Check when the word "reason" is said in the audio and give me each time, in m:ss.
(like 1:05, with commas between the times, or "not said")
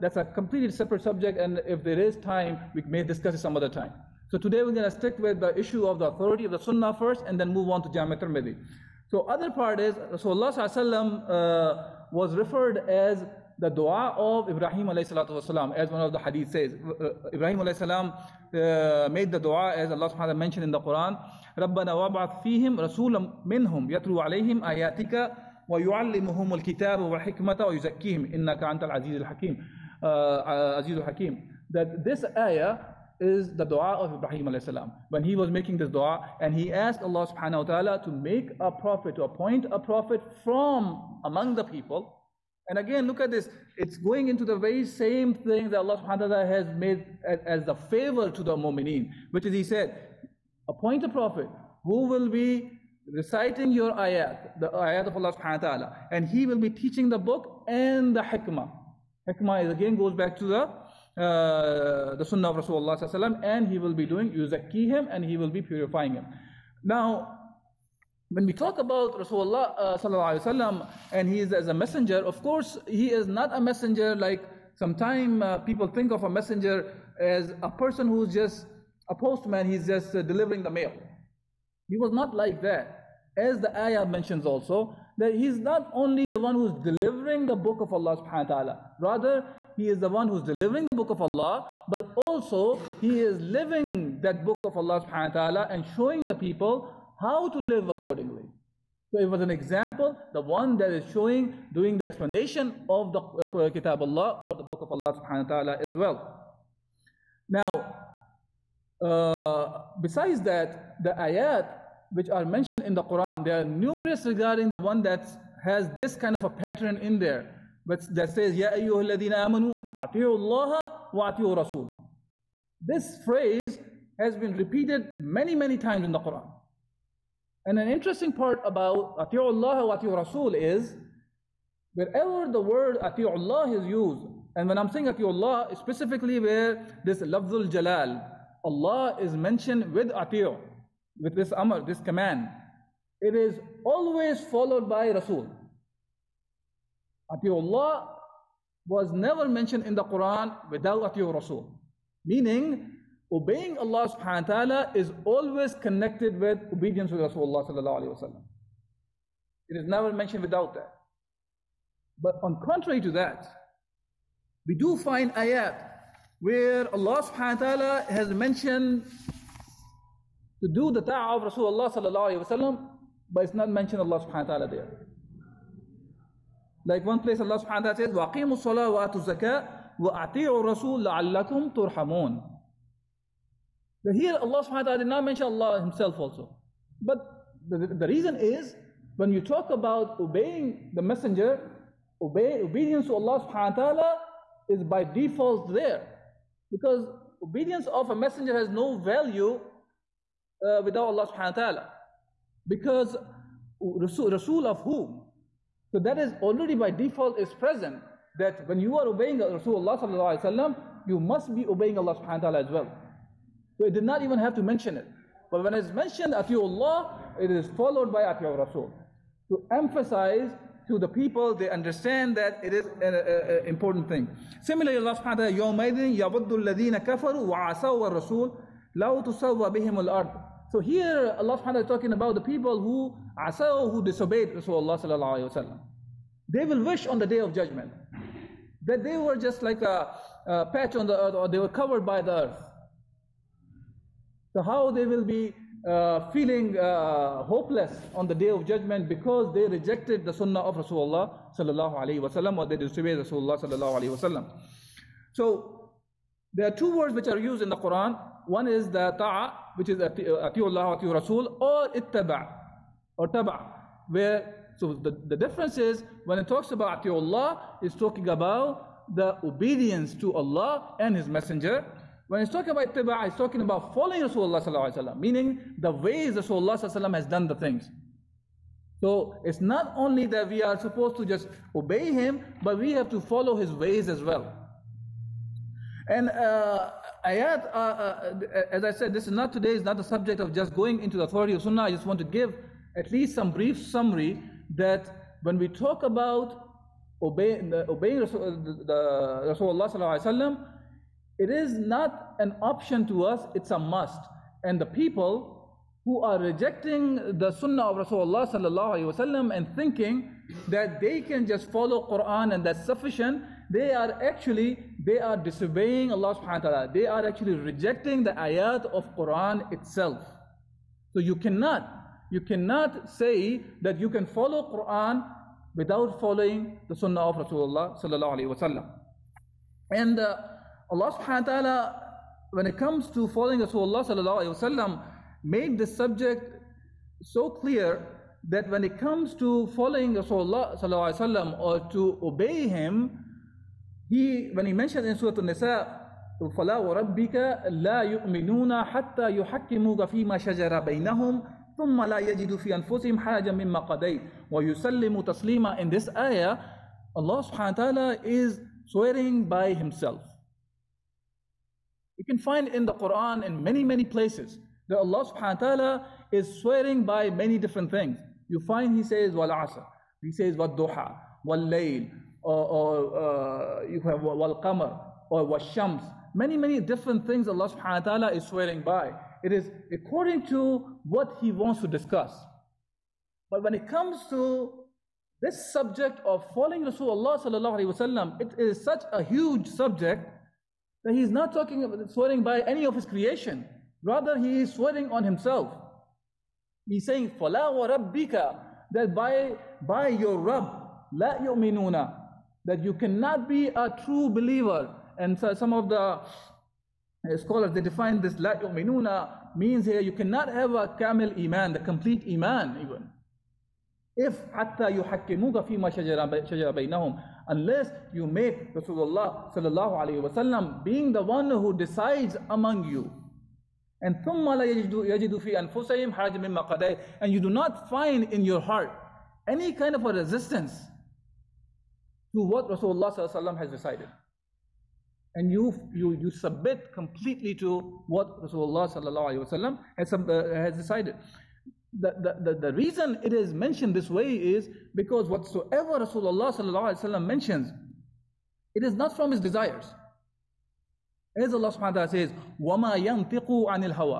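3:08, 7:22.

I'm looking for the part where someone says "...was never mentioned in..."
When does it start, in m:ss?
2:28.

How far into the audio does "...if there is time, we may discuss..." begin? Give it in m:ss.
0:01.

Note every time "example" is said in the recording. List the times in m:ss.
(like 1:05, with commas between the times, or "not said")
1:39.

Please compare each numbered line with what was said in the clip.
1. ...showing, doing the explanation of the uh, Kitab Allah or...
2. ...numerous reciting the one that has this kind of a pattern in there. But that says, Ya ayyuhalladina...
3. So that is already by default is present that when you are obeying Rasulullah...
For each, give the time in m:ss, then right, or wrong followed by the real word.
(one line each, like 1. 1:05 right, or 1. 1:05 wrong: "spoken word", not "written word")
1. 1:41 right
2. 1:53 wrong: "regarding", not "reciting"
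3. 3:25 right.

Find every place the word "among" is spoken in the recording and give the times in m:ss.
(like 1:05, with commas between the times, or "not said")
0:41, 7:02.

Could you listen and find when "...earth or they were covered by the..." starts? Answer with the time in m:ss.
4:01.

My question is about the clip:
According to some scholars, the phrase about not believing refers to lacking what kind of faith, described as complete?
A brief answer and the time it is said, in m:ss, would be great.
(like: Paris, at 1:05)
Kamil iman, at 6:50.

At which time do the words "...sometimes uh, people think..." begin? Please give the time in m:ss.
1:14.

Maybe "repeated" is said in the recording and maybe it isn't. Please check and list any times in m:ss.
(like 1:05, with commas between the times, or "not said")
2:04.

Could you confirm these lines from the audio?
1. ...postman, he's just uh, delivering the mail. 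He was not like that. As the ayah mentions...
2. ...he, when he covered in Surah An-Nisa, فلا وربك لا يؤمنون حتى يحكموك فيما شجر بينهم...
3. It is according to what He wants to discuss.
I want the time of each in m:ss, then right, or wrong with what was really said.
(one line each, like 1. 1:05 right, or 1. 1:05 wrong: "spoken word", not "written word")
1. 1:19 right
2. 5:44 wrong: "mentioned", not "covered"
3. 6:19 right.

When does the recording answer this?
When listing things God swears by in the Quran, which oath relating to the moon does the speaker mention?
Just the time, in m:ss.
6:14.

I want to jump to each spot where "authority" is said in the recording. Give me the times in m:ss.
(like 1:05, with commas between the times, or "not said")
0:06, 4:51.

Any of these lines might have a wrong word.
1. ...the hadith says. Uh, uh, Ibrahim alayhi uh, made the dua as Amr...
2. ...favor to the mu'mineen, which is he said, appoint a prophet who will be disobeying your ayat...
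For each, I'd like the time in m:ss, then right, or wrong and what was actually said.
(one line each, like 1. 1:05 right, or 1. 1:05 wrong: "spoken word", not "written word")
1. 0:16 wrong: "Allah", not "Amr"
2. 0:47 wrong: "reciting", not "disobeying".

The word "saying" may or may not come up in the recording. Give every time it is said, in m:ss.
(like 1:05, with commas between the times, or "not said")
2:14, 6:37.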